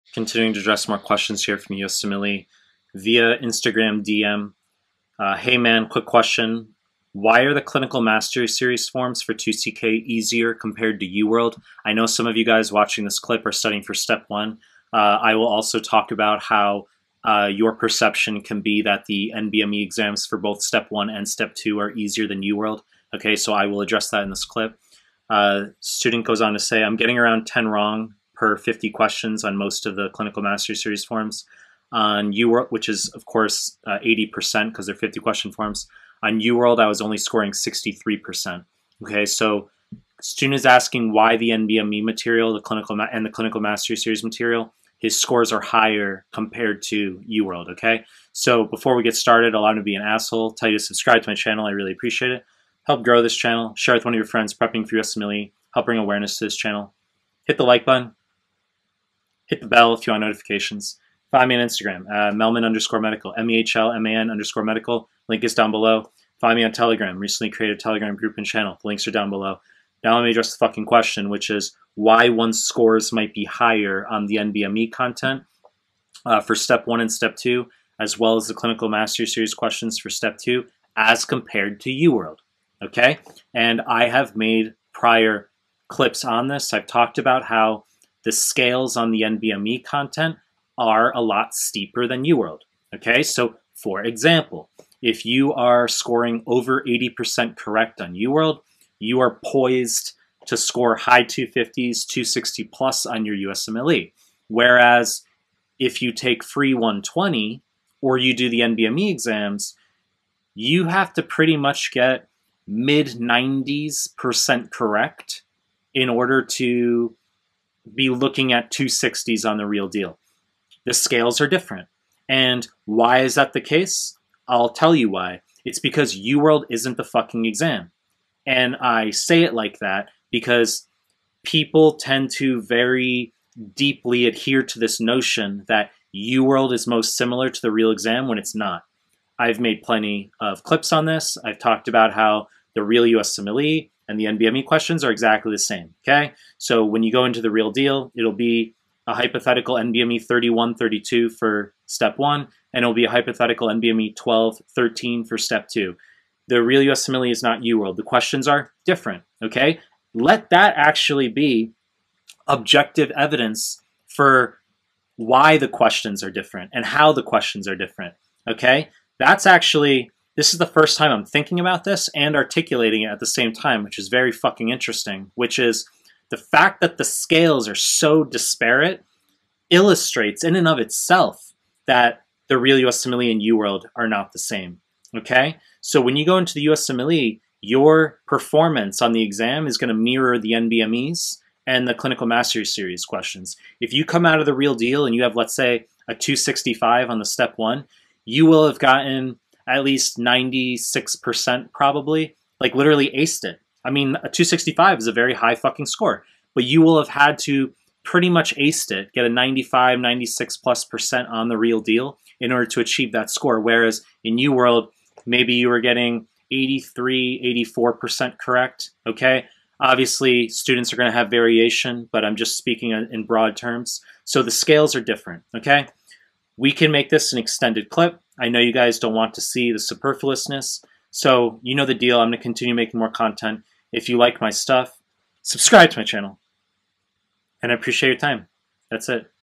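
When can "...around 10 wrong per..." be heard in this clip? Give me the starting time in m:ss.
0:27.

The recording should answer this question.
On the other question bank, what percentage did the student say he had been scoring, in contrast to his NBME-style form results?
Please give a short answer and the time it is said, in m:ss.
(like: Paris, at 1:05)
63%, at 0:37.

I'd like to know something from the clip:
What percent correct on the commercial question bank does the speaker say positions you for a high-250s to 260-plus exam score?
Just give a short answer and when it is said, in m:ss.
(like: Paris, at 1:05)
over 80%, at 1:36.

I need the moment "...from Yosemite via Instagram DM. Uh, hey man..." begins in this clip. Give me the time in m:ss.
0:01.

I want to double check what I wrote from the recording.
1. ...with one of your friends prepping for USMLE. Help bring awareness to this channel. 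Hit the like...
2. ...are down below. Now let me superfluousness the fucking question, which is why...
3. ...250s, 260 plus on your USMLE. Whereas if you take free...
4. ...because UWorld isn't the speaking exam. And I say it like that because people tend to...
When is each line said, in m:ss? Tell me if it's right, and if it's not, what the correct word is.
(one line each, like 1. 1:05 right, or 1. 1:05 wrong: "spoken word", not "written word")
1. 0:53 right
2. 1:09 wrong: "address", not "superfluousness"
3. 1:41 right
4. 2:05 wrong: "fucking", not "speaking".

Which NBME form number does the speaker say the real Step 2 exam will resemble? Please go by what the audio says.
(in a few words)
NBME 1213.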